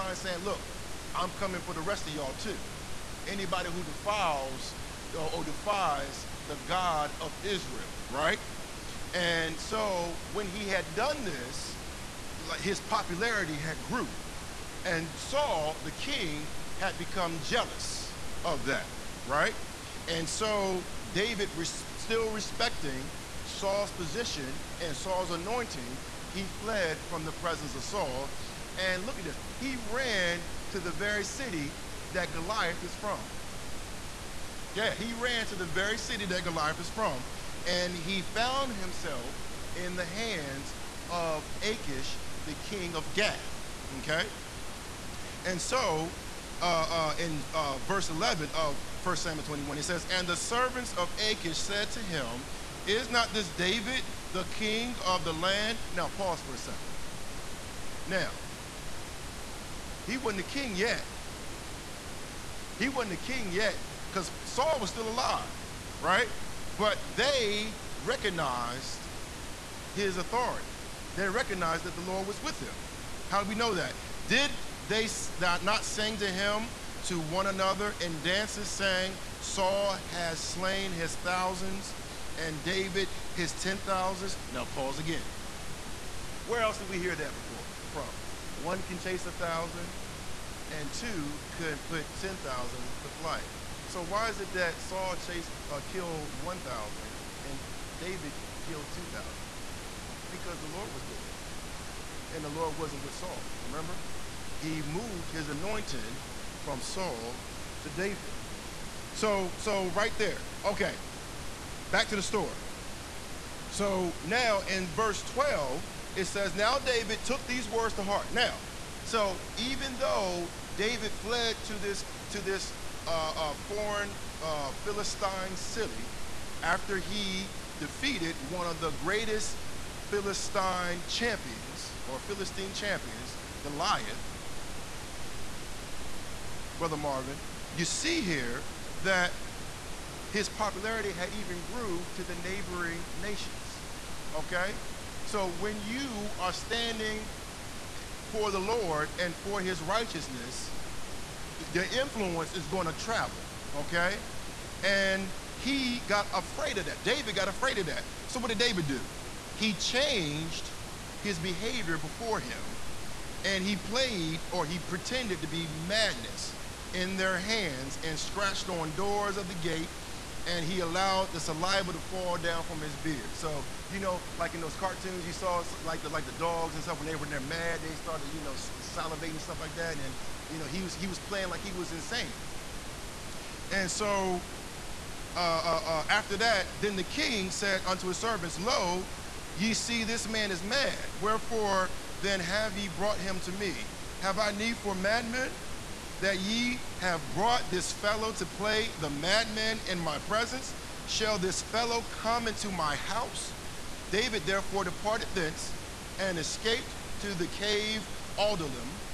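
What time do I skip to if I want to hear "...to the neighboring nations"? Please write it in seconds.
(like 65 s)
142 s.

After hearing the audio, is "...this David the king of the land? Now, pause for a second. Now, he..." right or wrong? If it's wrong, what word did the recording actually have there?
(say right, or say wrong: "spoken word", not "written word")
right.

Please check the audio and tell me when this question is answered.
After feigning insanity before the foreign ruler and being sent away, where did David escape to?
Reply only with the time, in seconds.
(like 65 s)
207 s.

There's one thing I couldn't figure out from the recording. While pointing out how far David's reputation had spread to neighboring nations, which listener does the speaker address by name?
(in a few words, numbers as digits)
Brother Marvin.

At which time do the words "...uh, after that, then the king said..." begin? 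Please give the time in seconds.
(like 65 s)
185 s.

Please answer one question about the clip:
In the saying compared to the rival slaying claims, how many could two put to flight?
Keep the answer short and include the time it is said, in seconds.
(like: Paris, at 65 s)
10,000, at 92 s.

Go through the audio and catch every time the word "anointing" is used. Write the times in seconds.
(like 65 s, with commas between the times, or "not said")
25 s, 105 s.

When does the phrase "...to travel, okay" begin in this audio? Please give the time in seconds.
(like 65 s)
152 s.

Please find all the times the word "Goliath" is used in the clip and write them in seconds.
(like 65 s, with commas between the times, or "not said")
32 s, 36 s, 133 s.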